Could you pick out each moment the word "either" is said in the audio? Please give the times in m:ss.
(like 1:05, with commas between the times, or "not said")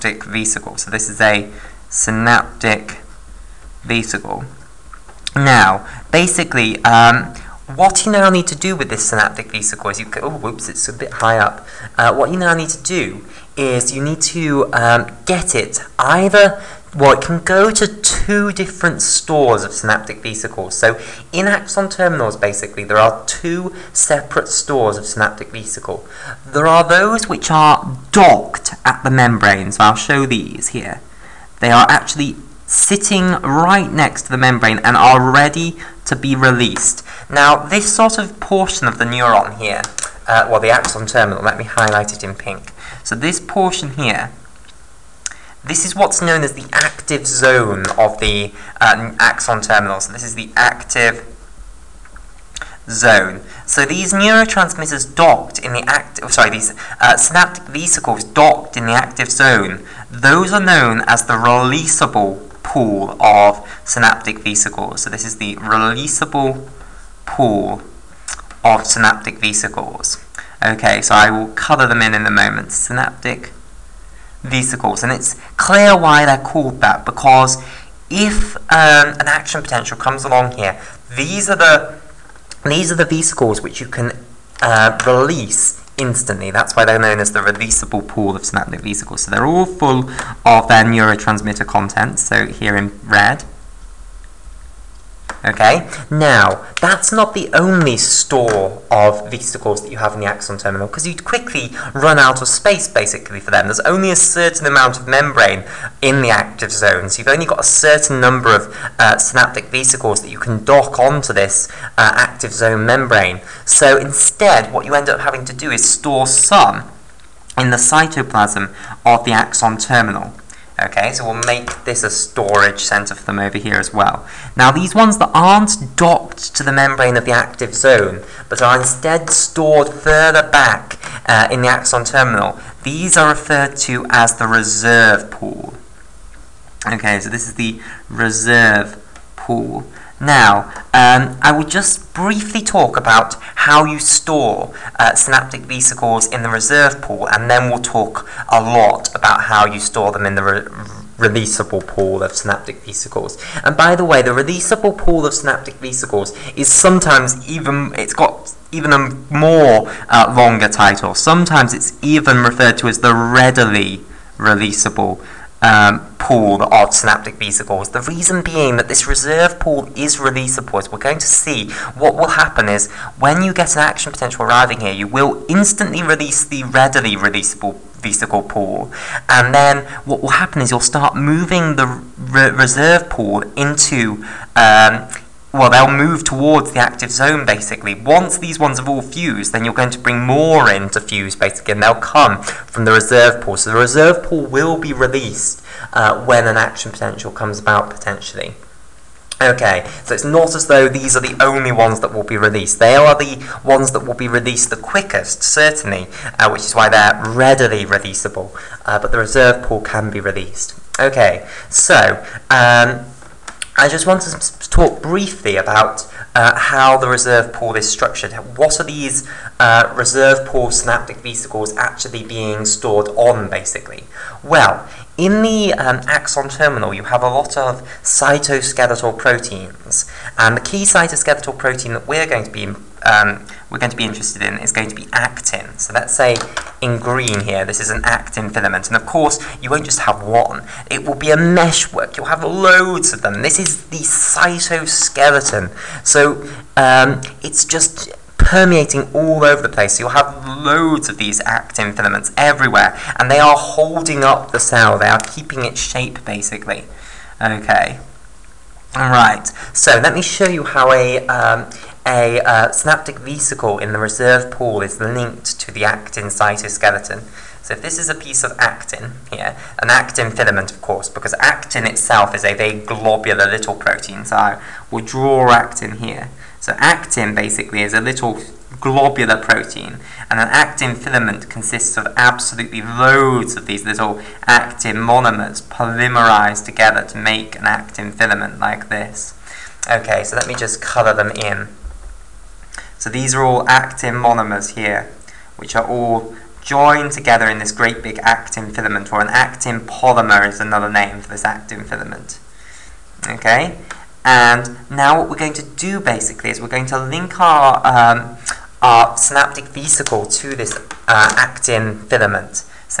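0:15.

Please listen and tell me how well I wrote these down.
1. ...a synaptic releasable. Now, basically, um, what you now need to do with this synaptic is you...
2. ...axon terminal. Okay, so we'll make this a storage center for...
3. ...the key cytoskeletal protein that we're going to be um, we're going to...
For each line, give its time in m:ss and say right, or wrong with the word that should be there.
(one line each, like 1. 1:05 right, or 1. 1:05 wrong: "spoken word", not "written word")
1. 0:01 wrong: "vesicle", not "releasable"
2. 1:59 right
3. 3:50 right.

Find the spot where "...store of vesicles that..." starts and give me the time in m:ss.
1:37.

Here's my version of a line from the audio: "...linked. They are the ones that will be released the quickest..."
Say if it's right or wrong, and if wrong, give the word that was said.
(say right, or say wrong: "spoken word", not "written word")
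wrong: "released", not "linked".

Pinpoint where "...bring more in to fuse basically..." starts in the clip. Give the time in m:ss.
3:09.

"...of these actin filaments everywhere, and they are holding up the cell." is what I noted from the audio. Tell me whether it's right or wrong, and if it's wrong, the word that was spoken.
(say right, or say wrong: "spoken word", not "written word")
right.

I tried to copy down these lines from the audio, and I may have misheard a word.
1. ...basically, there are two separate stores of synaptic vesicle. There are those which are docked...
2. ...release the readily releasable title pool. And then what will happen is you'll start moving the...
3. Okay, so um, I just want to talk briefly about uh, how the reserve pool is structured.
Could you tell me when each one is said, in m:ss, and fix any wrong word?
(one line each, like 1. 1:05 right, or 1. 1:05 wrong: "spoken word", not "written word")
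1. 0:22 right
2. 2:56 wrong: "vesicle", not "title"
3. 3:30 right.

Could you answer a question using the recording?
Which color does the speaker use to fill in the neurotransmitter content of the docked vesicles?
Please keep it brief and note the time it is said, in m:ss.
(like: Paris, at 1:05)
red, at 1:32.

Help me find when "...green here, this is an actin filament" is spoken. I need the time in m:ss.
3:56.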